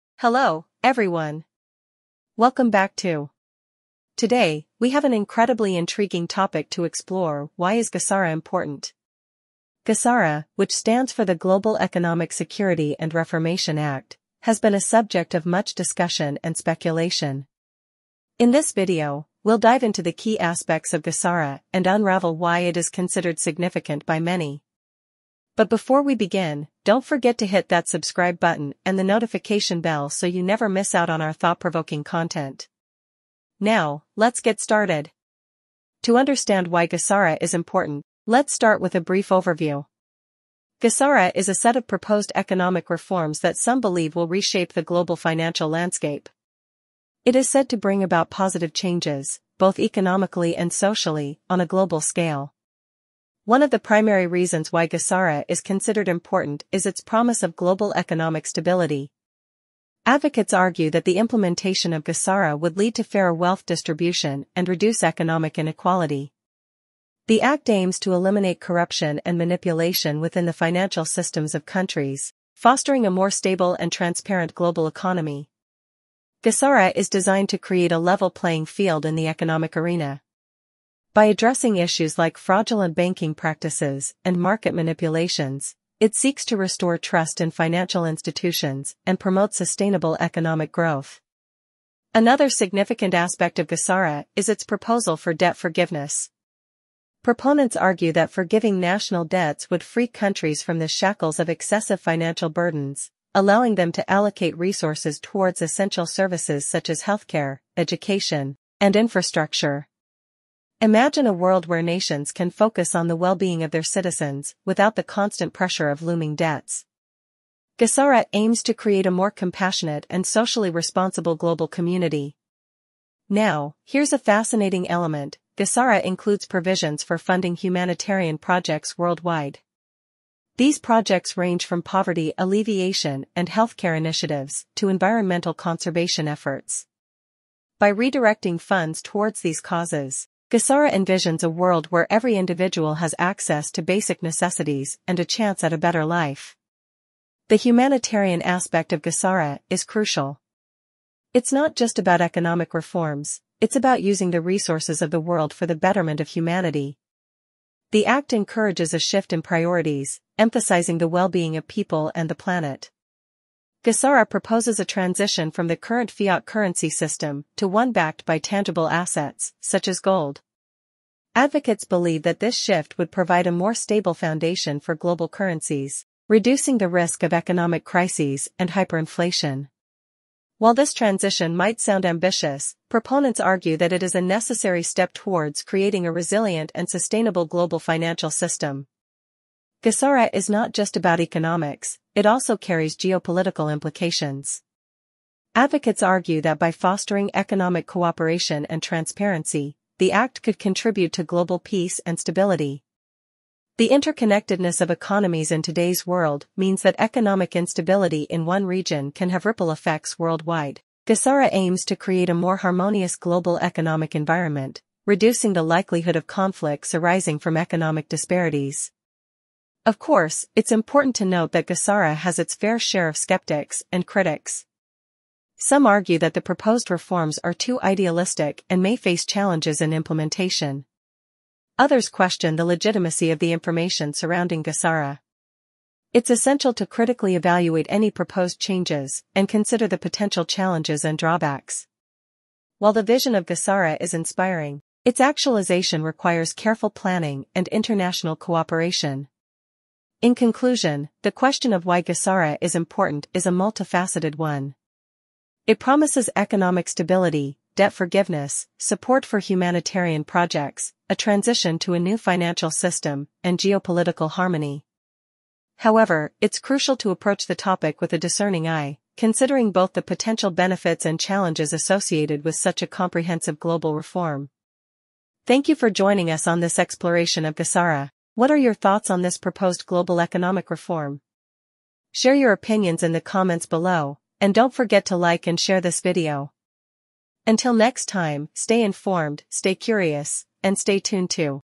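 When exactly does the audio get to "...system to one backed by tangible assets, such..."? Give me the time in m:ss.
2:46.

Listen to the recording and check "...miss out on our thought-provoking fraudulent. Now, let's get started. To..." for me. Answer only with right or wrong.
wrong.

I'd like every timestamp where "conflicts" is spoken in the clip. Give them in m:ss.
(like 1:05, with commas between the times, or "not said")
3:36.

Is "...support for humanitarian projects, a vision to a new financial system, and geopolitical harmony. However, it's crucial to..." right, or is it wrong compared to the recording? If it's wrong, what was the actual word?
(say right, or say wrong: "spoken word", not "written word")
wrong: "transition", not "vision".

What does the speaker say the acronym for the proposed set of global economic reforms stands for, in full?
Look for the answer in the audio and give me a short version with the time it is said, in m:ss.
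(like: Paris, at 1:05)
Global Economic Security and Reformation Act, at 0:11.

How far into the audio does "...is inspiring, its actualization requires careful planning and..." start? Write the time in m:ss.
4:03.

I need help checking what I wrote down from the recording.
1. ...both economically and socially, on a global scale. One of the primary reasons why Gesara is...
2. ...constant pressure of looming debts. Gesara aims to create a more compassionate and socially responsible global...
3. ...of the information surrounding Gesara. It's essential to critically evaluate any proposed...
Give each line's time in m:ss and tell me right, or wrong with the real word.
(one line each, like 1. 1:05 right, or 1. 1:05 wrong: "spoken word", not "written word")
1. 0:49 right
2. 1:55 right
3. 3:53 right.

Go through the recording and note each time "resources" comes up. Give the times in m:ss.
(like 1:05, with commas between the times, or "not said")
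1:44, 2:34.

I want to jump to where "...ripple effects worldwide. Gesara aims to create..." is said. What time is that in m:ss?
3:29.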